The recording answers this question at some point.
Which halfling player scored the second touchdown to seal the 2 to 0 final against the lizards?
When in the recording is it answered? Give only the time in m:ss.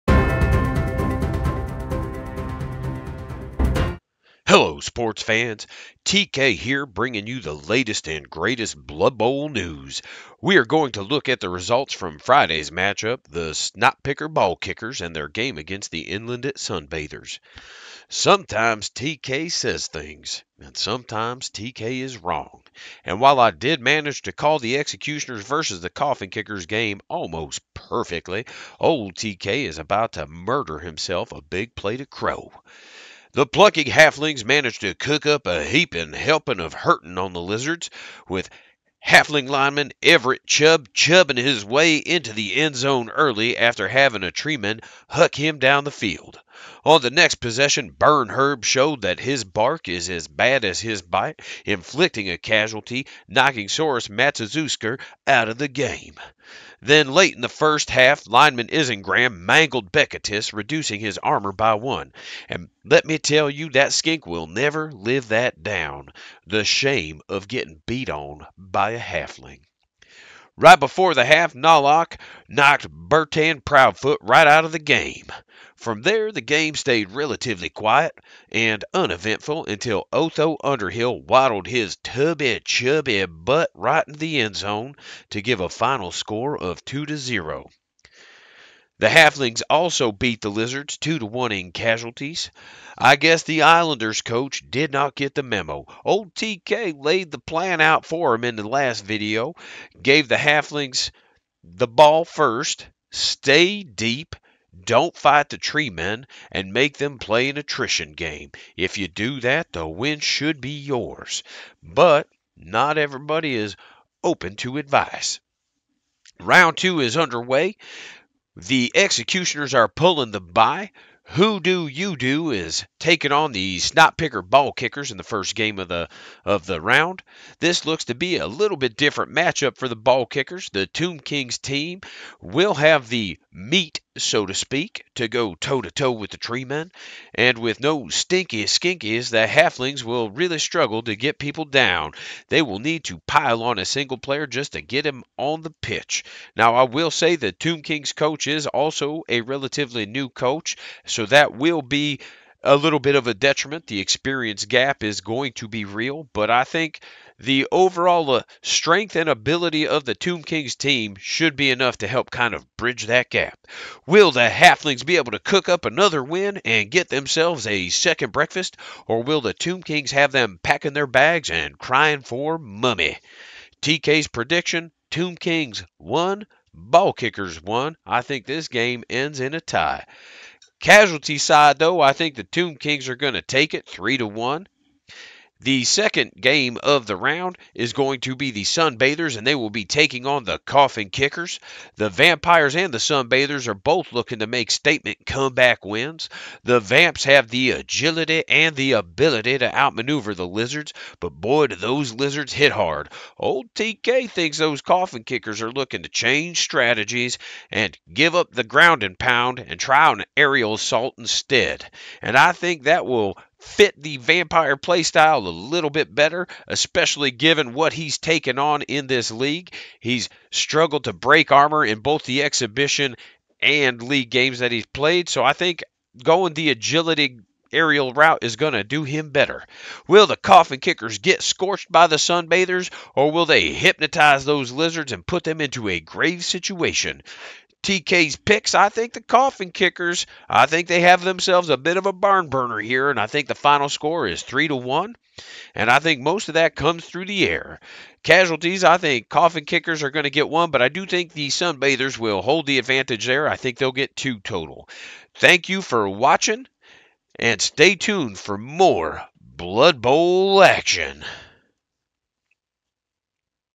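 1:20.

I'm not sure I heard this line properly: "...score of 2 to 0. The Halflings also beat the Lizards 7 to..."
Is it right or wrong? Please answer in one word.
wrong.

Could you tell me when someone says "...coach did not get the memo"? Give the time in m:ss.
1:34.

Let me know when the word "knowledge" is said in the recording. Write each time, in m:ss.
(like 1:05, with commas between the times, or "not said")
not said.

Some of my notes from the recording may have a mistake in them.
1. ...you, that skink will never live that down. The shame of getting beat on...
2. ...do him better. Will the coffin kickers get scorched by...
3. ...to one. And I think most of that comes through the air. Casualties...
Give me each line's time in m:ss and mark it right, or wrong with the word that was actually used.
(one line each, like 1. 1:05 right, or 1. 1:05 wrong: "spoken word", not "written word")
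1. 1:03 right
2. 3:48 right
3. 4:04 right.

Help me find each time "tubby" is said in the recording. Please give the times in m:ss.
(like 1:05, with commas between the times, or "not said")
1:22.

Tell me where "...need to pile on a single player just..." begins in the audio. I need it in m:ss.
2:22.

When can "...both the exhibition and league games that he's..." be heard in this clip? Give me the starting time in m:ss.
3:41.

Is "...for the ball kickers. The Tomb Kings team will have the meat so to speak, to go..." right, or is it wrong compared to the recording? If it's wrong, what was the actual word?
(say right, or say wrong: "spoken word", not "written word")
right.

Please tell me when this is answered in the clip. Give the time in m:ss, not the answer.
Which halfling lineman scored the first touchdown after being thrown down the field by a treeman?
0:40.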